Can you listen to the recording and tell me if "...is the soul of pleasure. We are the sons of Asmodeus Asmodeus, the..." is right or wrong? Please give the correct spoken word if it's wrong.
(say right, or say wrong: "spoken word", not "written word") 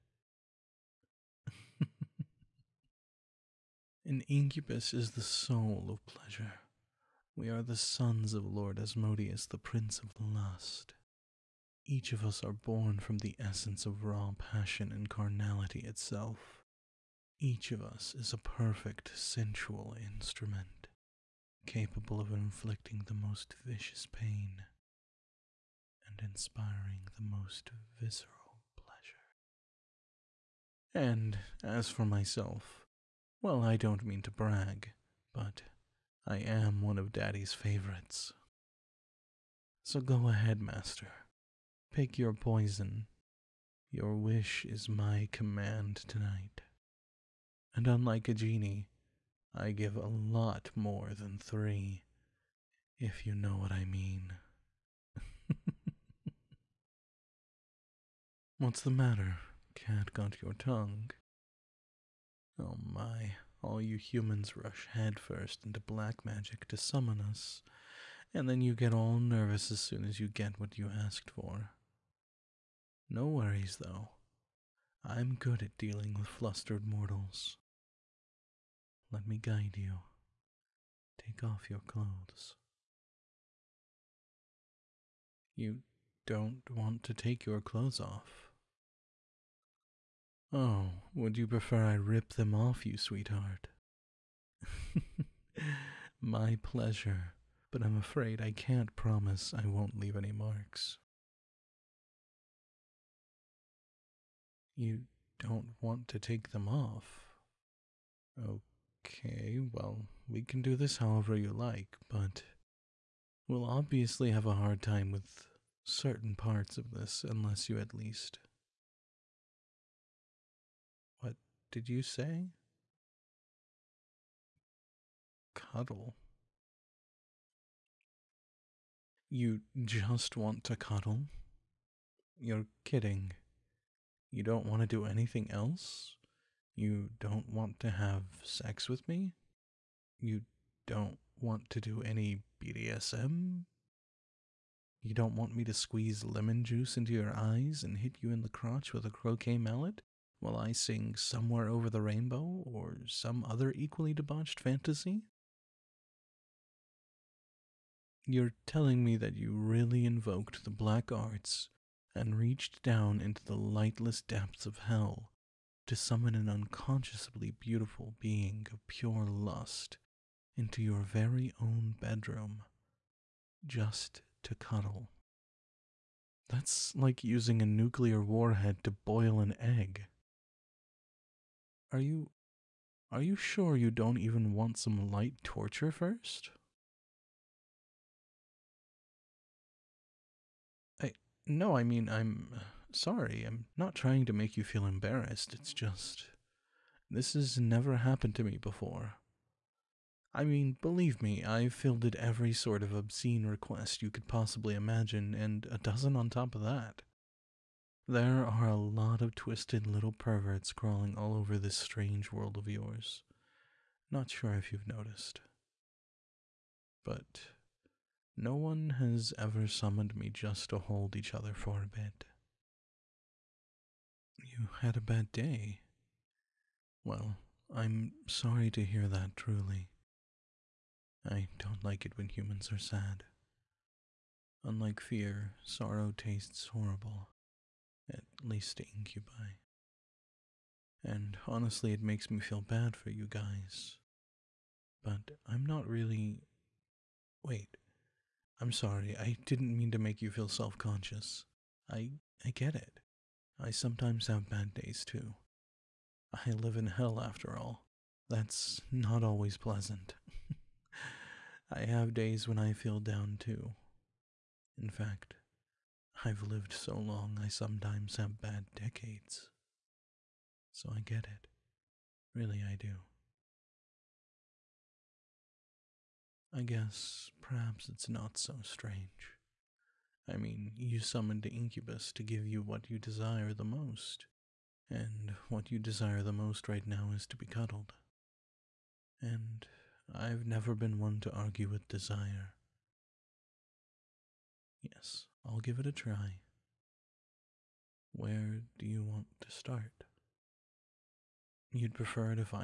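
wrong: "Lord", not "Asmodeus".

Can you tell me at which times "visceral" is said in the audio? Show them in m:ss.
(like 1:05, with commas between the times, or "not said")
0:27.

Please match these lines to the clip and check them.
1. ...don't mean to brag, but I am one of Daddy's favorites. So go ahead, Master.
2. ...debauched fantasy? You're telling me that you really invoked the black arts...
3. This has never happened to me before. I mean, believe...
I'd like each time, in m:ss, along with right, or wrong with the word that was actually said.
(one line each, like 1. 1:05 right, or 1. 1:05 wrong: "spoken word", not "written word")
1. 0:33 right
2. 2:34 right
3. 3:17 right.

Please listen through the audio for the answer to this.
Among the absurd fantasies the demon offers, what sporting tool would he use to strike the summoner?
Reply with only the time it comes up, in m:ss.
2:29.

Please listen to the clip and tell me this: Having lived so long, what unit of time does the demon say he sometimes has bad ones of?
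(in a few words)
decades.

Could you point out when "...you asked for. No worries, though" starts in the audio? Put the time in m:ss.
1:10.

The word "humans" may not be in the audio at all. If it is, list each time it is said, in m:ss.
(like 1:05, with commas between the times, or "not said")
1:03, 3:52.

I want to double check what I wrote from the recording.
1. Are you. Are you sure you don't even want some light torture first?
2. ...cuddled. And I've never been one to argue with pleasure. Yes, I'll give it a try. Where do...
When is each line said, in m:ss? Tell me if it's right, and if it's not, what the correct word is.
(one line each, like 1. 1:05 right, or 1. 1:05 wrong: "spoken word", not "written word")
1. 3:01 right
2. 4:47 wrong: "desire", not "pleasure".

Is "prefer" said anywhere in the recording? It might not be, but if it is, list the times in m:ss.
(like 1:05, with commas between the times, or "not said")
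1:31, 5:01.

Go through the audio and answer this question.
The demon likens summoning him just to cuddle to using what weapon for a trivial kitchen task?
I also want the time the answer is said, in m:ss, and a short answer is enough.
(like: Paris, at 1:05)
nuclear warhead, at 2:57.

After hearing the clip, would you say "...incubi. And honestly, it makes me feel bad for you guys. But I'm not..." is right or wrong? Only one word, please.
right.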